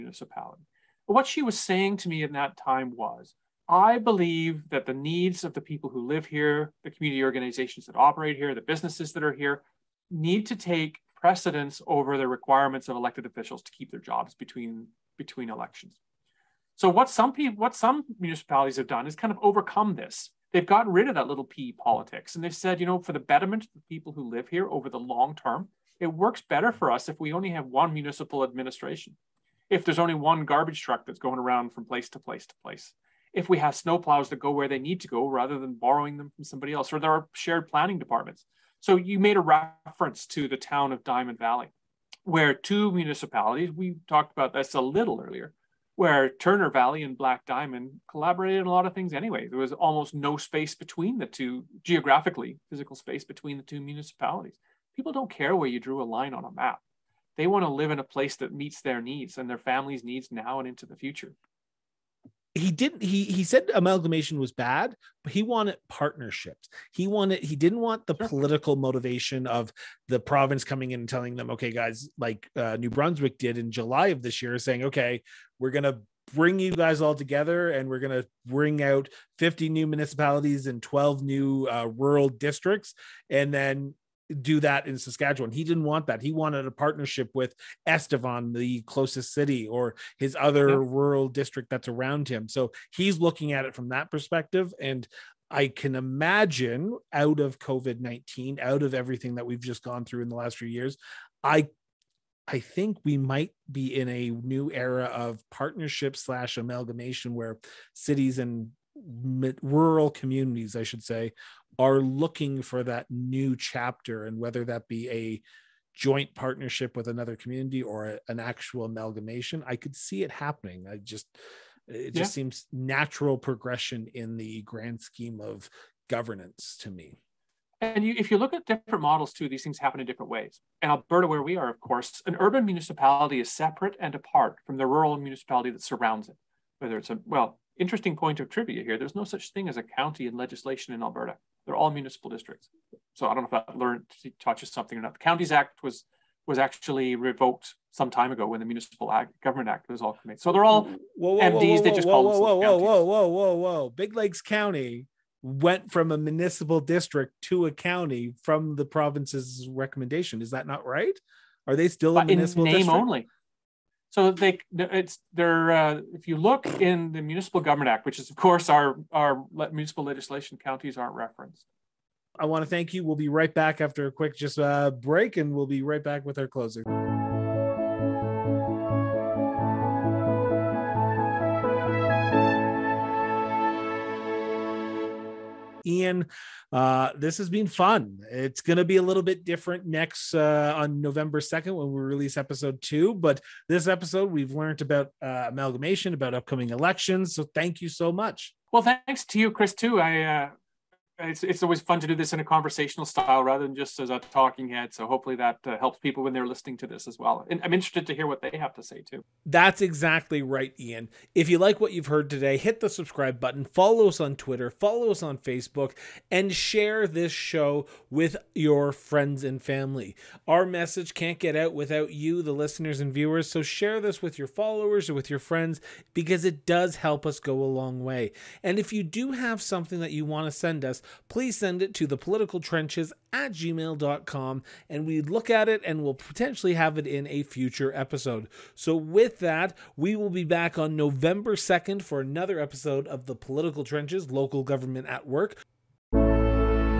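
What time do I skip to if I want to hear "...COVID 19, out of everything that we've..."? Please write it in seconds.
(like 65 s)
97 s.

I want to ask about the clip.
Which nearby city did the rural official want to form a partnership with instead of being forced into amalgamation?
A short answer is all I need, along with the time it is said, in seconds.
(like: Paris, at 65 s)
Estevan, at 87 s.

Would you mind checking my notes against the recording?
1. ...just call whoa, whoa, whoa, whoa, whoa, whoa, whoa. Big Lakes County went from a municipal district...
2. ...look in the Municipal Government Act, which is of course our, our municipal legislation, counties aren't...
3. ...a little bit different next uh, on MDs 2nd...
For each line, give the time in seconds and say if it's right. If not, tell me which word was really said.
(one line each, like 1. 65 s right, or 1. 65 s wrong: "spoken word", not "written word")
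1. 151 s right
2. 166 s right
3. 188 s wrong: "November", not "MDs".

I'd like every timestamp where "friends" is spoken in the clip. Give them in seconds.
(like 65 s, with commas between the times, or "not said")
218 s, 225 s.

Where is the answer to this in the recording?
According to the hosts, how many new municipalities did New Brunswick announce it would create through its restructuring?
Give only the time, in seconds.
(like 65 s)
79 s.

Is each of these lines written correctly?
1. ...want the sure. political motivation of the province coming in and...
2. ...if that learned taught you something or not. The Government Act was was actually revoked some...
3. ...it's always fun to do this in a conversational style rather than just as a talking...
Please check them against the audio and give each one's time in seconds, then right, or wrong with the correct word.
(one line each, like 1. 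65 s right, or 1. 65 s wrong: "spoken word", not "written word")
1. 67 s right
2. 143 s wrong: "Counties", not "Government"
3. 201 s right.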